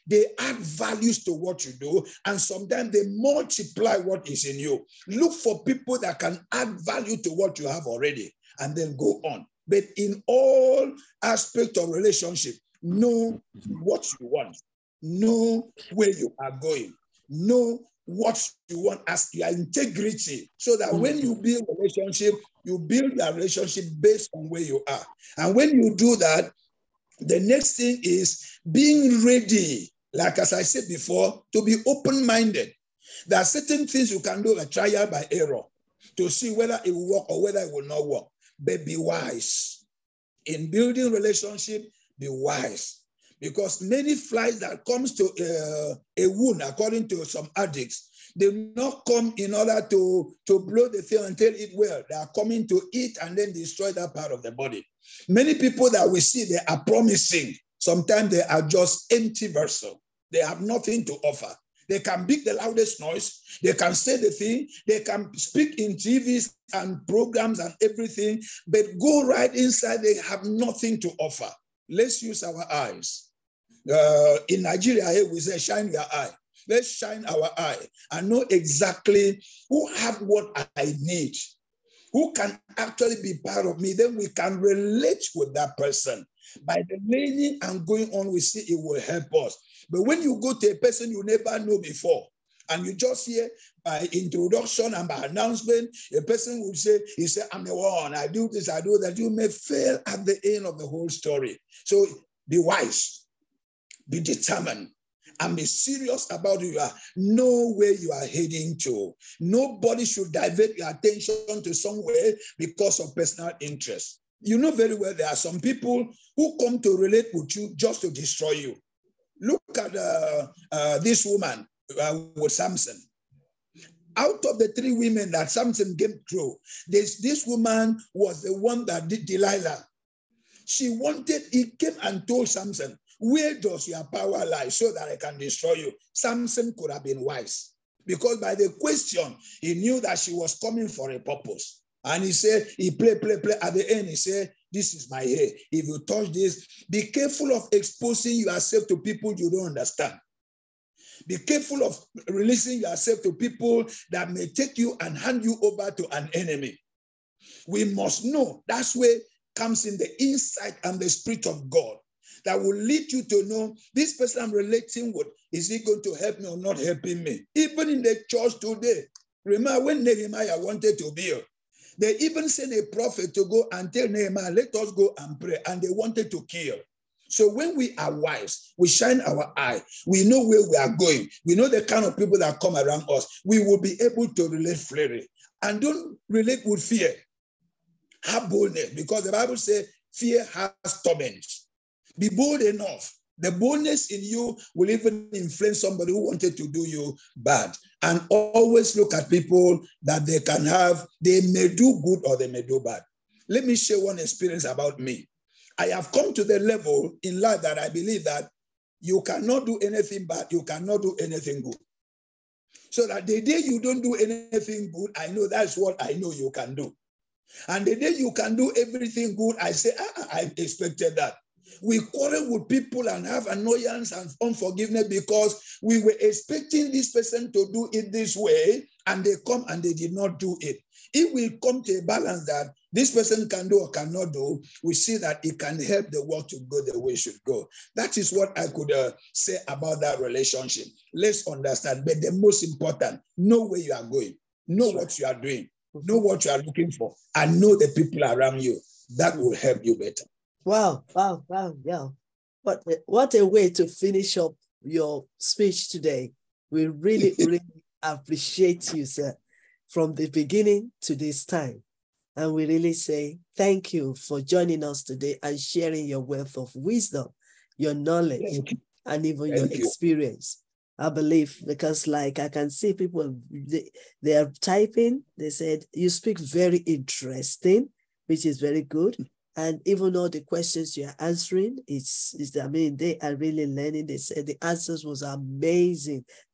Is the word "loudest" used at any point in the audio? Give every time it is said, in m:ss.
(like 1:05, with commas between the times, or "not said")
1:02.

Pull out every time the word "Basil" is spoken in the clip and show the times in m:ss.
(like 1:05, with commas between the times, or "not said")
not said.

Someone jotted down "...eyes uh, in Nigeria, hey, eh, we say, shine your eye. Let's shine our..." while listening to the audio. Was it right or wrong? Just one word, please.
right.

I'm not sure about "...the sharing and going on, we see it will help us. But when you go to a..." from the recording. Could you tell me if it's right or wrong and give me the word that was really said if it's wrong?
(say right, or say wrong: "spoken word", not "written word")
wrong: "learning", not "sharing".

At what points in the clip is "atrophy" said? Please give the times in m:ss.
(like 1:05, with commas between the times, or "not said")
not said.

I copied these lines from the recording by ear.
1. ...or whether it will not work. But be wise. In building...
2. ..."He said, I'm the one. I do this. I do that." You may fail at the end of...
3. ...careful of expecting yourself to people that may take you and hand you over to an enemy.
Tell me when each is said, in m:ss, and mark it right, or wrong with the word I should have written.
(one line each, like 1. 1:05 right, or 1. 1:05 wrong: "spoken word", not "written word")
1. 0:37 right
2. 1:37 right
3. 2:31 wrong: "releasing", not "expecting".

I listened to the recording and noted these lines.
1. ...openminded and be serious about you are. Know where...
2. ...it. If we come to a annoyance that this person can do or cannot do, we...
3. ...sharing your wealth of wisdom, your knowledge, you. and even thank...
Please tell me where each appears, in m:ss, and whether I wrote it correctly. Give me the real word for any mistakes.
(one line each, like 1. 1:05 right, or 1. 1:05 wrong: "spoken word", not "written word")
1. 1:44 wrong: "determined", not "openminded"
2. 3:50 wrong: "balance", not "annoyance"
3. 4:25 right.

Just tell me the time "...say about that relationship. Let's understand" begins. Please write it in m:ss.
3:59.